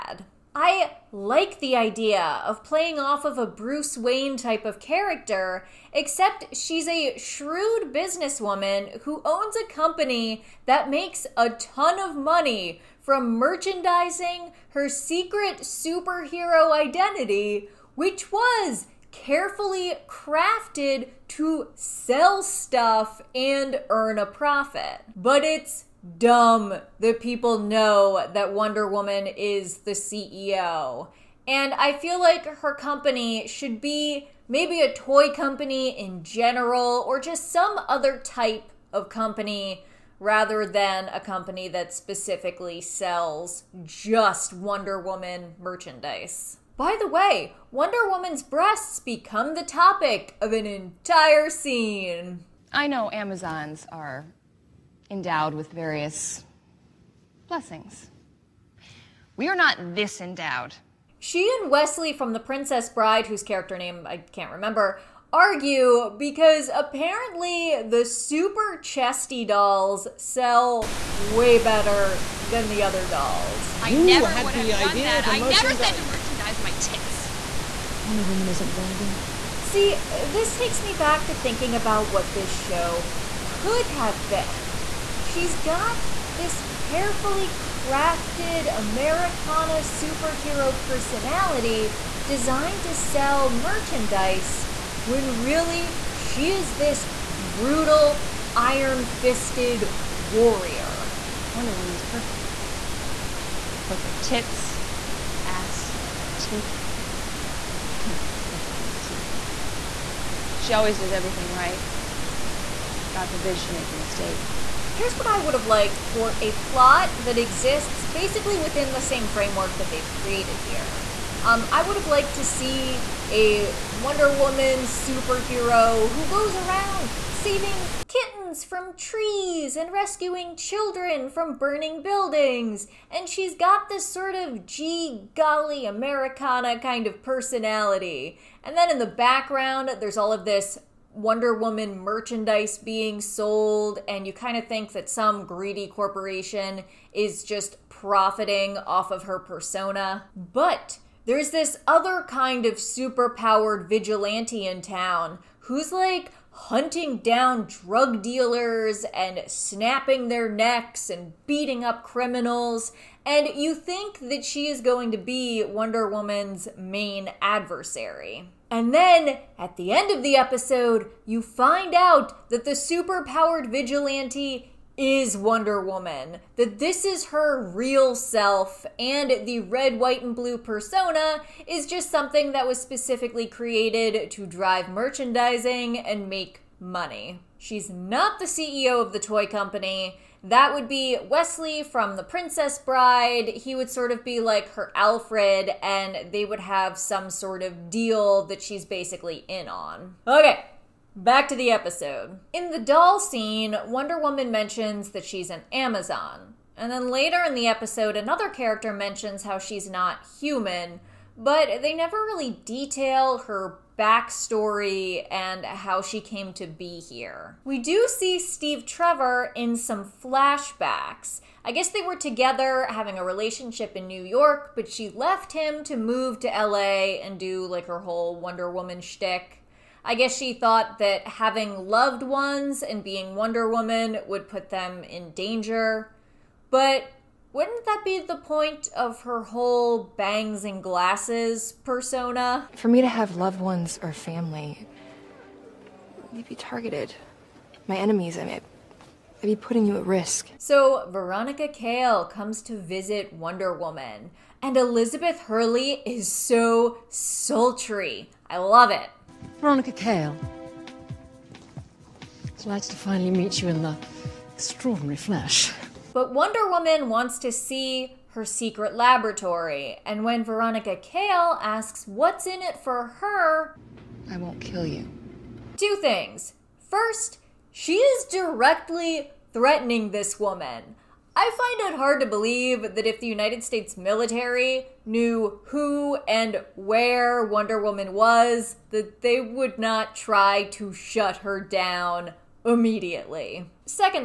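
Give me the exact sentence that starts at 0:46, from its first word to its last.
By the way, Wonder Woman's breasts become the topic of an entire scene.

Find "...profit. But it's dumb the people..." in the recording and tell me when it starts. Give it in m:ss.
0:24.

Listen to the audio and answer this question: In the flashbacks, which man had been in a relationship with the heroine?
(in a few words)
Steve Trevor.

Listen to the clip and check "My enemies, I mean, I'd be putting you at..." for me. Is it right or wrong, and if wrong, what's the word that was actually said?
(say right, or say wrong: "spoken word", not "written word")
right.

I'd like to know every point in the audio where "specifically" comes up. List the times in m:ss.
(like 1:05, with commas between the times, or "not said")
0:41, 3:02.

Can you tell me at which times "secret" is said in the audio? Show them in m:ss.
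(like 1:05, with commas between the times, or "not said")
0:14, 4:28.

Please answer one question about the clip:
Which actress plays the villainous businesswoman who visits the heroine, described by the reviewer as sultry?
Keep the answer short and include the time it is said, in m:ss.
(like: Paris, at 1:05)
Elizabeth Hurley, at 4:14.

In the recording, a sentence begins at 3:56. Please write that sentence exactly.
But wouldn't that be the point of her whole bangs and glasses persona?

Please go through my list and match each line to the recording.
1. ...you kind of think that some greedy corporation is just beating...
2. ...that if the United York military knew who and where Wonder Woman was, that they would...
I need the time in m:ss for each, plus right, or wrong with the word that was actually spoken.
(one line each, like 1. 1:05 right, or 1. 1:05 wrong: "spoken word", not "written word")
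1. 2:24 wrong: "profiting", not "beating"
2. 4:42 wrong: "States", not "York".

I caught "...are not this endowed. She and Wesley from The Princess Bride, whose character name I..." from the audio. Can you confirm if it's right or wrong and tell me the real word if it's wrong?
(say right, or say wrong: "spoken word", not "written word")
right.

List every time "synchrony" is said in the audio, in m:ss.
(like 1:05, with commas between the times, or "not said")
not said.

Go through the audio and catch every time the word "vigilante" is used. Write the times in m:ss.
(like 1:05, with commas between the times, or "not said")
2:33, 2:53.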